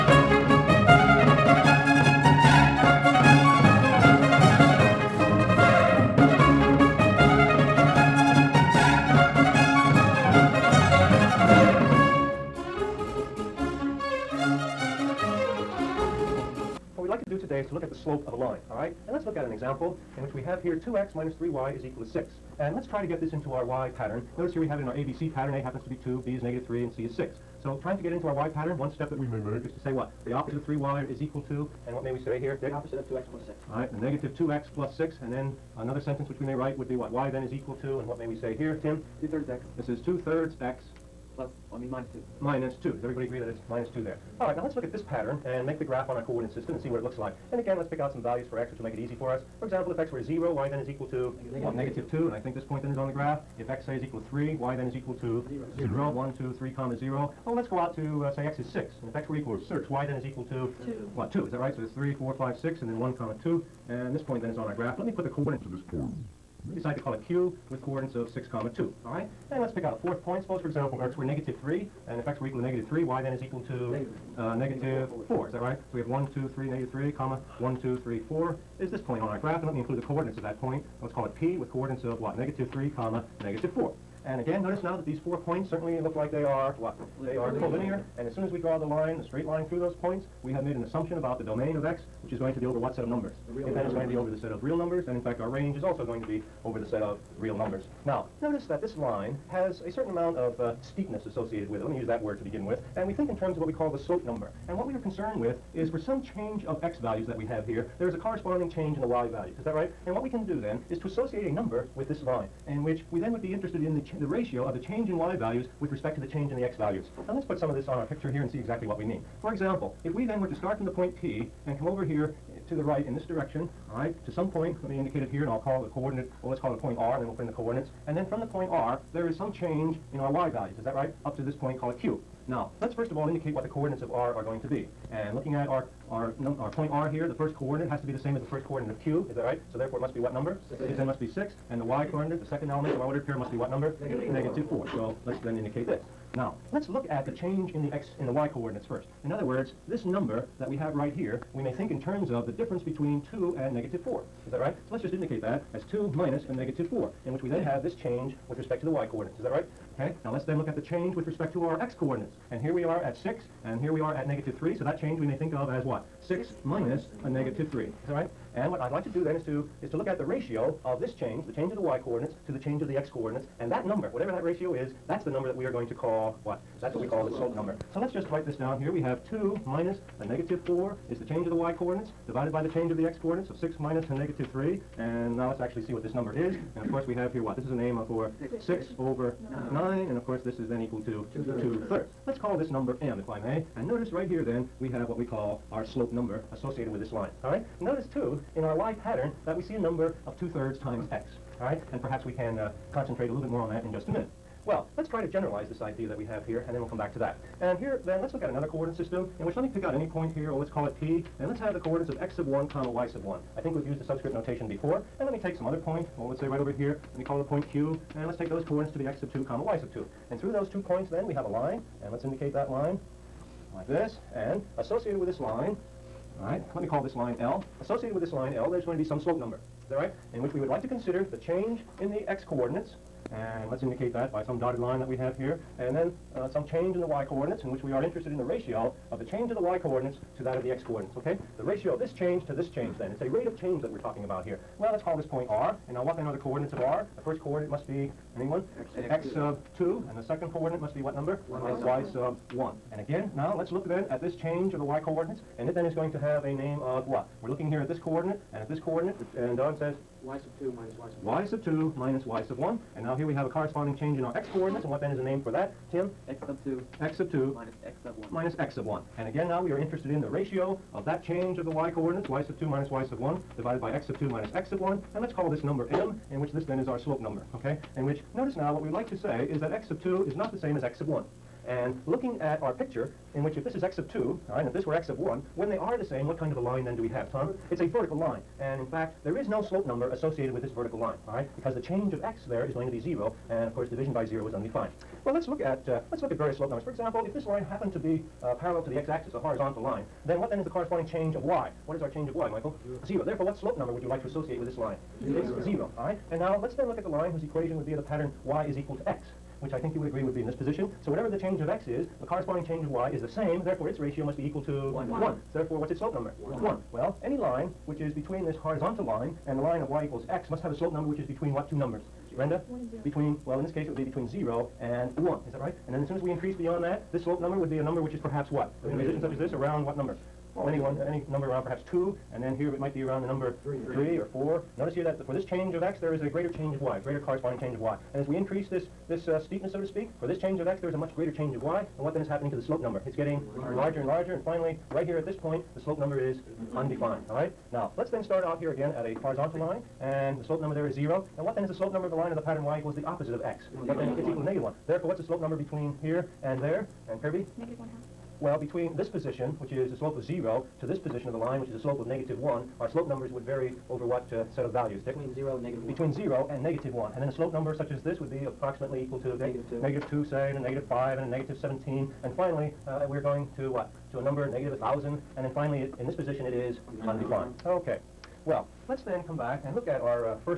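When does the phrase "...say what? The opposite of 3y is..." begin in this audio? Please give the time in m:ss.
0:29.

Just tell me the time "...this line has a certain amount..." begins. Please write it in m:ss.
1:38.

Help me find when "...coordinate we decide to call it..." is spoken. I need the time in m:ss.
1:05.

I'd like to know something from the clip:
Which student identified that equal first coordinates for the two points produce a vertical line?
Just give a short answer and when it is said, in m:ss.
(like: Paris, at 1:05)
Tom, at 4:47.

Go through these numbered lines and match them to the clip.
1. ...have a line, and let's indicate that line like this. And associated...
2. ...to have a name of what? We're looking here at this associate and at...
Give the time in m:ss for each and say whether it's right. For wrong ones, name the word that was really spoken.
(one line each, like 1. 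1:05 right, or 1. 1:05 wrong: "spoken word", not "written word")
1. 3:41 right
2. 4:16 wrong: "coordinate", not "associate".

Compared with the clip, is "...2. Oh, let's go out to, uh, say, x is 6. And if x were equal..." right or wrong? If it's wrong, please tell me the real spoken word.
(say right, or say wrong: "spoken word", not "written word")
wrong: "0", not "2".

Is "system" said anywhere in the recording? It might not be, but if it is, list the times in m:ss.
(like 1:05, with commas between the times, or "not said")
0:46, 3:28.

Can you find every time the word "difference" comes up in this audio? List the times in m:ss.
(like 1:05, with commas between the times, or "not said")
2:32.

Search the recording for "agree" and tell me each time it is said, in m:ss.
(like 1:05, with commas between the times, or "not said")
0:43, 5:10.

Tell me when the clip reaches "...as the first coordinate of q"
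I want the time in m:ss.
2:18.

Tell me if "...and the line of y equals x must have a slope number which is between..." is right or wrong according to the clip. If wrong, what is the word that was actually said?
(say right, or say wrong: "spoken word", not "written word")
right.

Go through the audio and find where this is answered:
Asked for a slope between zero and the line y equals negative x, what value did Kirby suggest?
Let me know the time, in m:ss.
5:57.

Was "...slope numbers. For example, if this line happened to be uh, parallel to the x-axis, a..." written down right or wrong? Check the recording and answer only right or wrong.
right.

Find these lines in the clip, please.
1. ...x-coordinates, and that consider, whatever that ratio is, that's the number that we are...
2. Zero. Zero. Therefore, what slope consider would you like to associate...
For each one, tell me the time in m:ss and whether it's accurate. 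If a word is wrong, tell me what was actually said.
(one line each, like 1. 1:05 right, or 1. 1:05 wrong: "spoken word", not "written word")
1. 2:52 wrong: "number", not "consider"
2. 5:02 wrong: "number", not "consider".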